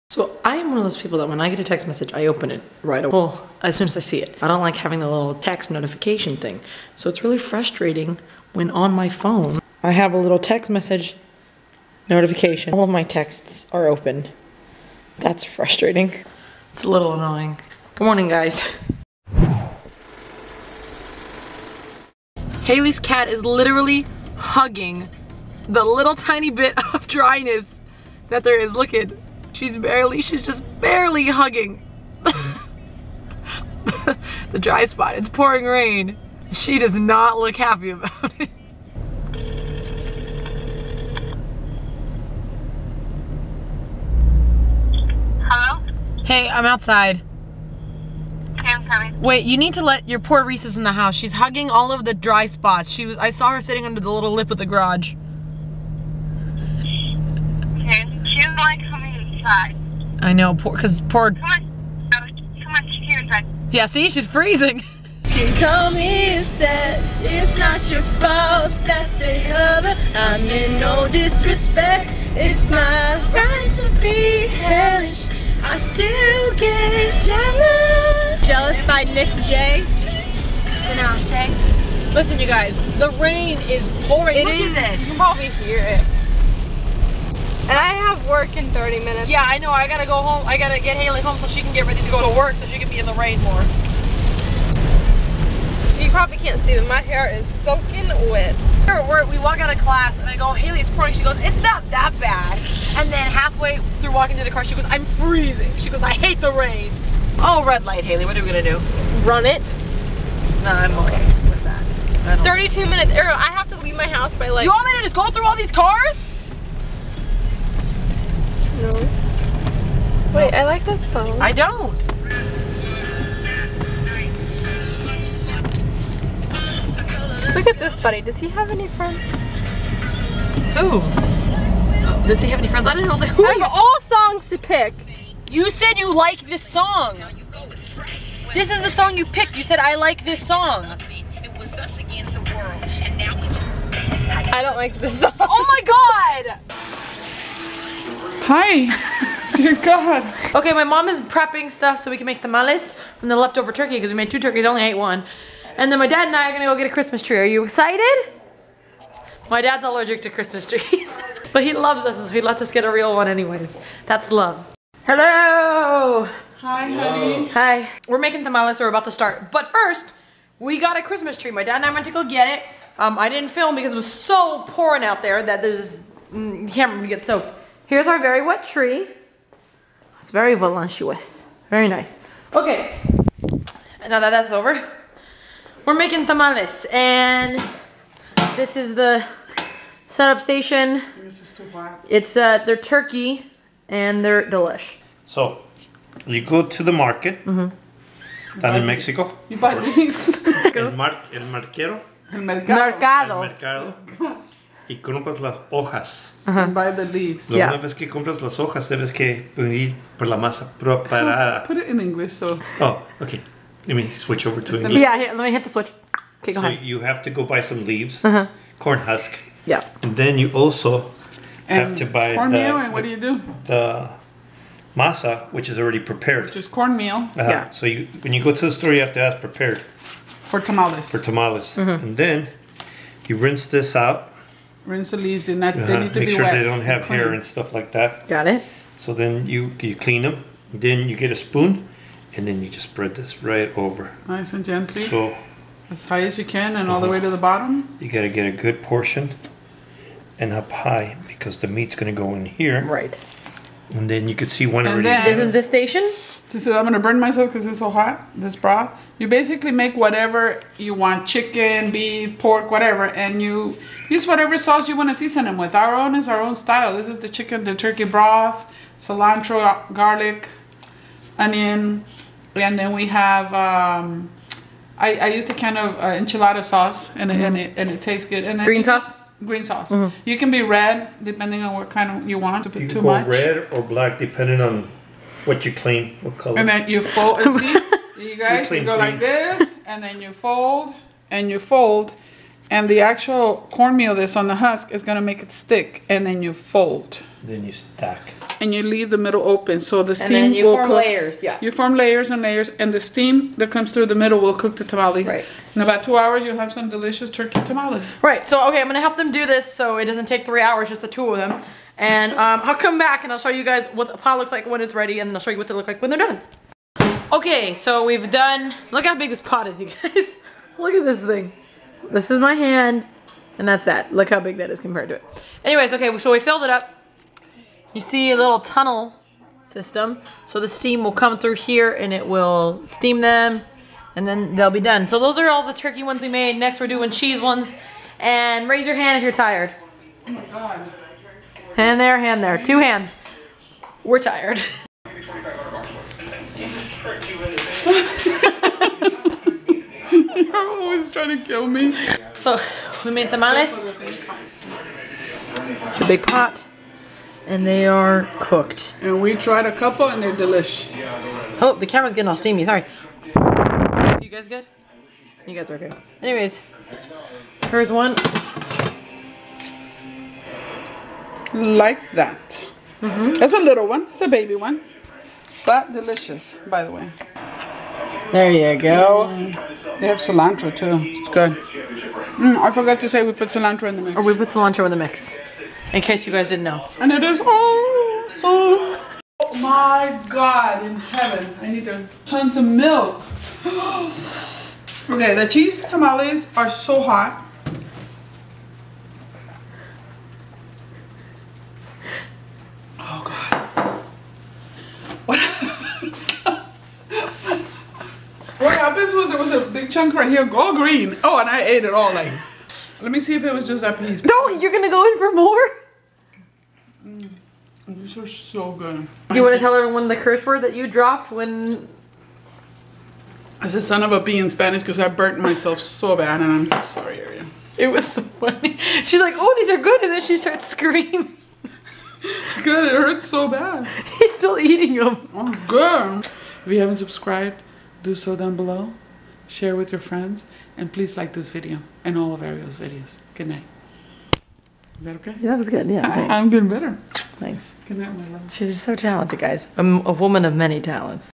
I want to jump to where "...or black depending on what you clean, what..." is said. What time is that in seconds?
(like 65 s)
283 s.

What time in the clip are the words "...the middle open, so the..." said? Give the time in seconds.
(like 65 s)
299 s.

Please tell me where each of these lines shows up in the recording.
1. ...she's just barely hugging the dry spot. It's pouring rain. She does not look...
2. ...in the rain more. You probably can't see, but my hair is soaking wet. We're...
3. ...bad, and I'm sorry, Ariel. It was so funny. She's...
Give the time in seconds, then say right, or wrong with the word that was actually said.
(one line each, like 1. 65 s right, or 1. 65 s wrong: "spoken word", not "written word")
1. 30 s right
2. 92 s right
3. 426 s right.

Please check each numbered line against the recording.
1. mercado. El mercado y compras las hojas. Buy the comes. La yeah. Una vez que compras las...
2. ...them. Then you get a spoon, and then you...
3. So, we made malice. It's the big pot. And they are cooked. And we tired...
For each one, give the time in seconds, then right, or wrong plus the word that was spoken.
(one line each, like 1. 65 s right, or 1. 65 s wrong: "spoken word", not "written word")
1. 202 s wrong: "leaves", not "comes"
2. 240 s right
3. 352 s wrong: "tried", not "tired".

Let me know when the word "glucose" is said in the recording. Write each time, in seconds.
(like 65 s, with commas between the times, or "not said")
not said.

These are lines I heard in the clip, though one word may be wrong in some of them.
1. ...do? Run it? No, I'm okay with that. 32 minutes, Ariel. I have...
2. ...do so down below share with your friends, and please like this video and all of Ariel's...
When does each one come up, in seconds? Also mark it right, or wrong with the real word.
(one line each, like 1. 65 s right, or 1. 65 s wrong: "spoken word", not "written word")
1. 108 s right
2. 438 s right.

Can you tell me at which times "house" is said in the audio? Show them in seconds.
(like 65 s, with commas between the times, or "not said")
50 s, 114 s.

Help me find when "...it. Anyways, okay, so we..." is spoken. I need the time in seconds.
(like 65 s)
325 s.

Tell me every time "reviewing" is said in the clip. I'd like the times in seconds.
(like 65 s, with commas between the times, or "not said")
not said.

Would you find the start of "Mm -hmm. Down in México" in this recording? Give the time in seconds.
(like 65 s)
197 s.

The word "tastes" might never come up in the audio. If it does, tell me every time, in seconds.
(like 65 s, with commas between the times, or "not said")
278 s.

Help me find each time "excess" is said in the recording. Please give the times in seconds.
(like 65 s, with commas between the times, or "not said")
not said.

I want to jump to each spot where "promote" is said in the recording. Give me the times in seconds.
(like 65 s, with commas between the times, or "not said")
not said.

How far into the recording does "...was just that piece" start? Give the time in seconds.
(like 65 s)
413 s.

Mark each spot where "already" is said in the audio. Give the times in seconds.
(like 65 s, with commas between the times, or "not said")
225 s, 255 s.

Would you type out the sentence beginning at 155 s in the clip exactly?
And then my dad and I are gonna go get a Christmas tree.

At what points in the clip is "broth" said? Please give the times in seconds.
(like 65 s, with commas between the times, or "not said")
258 s, 268 s.